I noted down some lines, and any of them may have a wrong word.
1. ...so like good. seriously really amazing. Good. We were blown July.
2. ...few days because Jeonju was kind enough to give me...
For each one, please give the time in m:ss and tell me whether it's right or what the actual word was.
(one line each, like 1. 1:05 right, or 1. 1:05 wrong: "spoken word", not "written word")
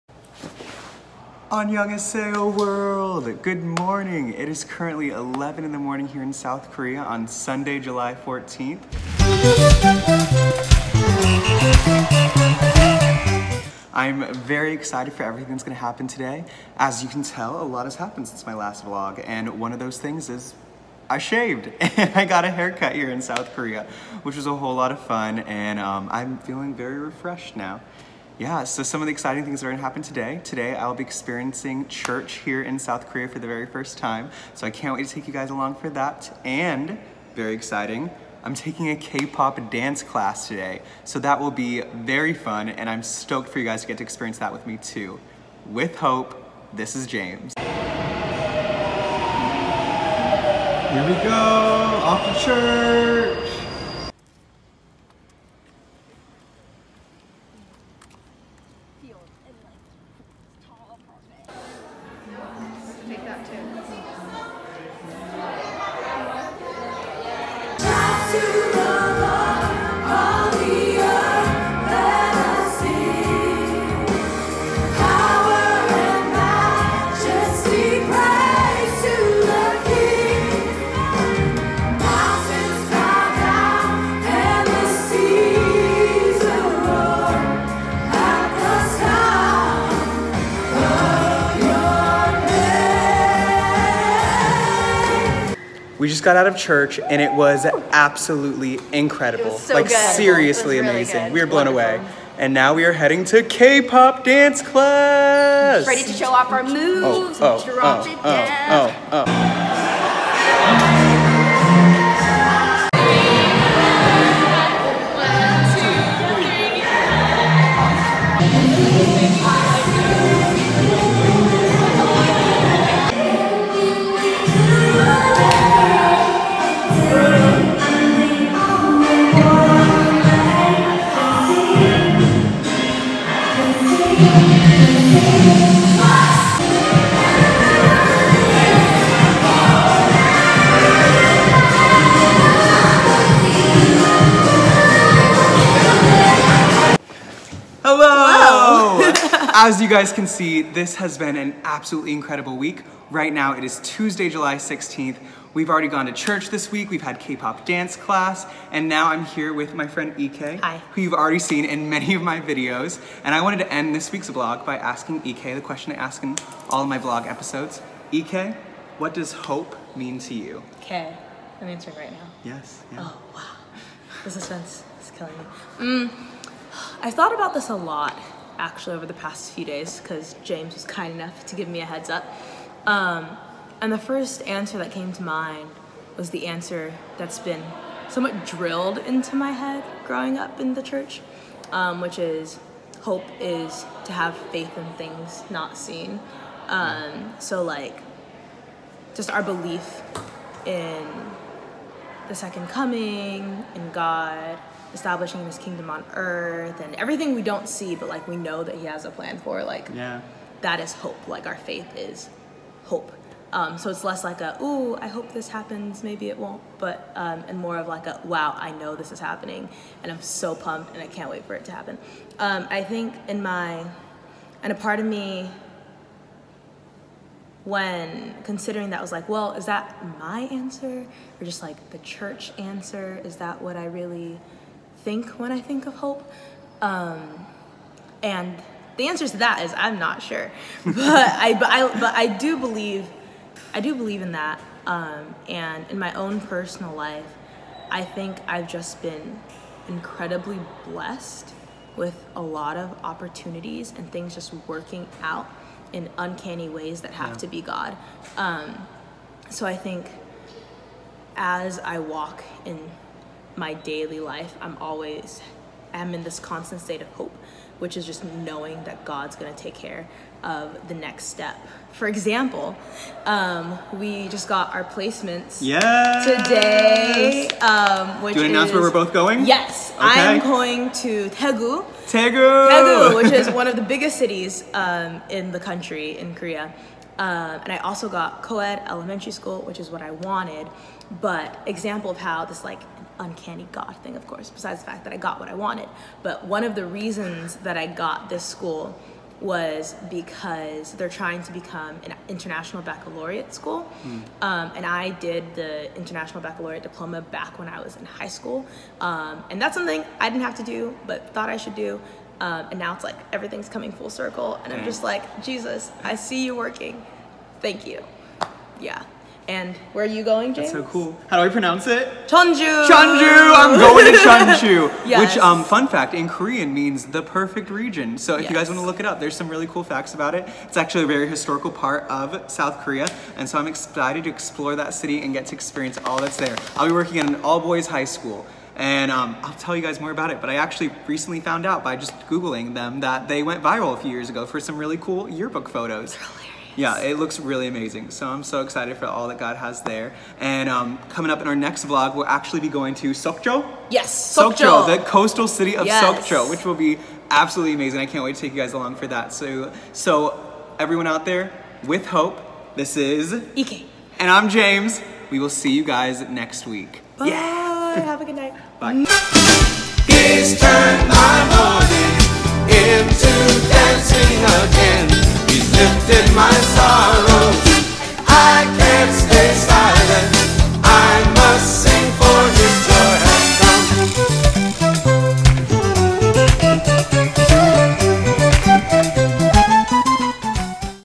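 1. 1:39 wrong: "Wonderful", not "July"
2. 2:59 wrong: "James", not "Jeonju".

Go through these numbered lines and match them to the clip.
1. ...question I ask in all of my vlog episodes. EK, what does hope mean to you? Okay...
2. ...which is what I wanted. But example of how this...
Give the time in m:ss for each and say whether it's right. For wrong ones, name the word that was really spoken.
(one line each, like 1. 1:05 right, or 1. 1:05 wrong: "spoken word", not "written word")
1. 2:45 right
2. 4:49 right.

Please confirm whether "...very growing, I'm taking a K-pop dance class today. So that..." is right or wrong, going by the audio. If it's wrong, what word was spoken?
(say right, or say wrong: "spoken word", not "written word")
wrong: "exciting", not "growing".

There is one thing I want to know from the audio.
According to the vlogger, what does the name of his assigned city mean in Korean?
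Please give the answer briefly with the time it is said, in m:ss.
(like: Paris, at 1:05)
the perfect region, at 5:27.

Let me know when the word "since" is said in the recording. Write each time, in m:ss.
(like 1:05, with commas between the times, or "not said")
0:18.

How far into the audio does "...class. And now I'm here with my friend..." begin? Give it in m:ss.
2:37.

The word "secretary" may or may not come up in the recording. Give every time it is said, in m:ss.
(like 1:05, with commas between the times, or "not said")
not said.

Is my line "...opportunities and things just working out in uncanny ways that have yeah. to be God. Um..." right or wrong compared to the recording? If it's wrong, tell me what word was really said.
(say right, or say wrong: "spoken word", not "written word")
right.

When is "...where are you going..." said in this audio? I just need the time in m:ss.
5:19.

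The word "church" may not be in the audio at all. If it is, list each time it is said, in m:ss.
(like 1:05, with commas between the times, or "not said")
0:31, 0:52, 1:36, 2:36, 3:10, 3:51.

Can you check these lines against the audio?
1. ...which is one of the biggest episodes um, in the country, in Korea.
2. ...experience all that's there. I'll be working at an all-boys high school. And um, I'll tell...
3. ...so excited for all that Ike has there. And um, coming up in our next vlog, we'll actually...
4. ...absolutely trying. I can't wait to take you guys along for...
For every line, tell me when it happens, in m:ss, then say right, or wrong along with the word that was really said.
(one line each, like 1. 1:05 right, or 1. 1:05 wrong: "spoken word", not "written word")
1. 4:43 wrong: "cities", not "episodes"
2. 5:35 right
3. 5:48 wrong: "God", not "Ike"
4. 5:57 wrong: "amazing", not "trying".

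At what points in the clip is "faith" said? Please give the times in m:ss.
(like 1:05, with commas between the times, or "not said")
3:14, 3:31.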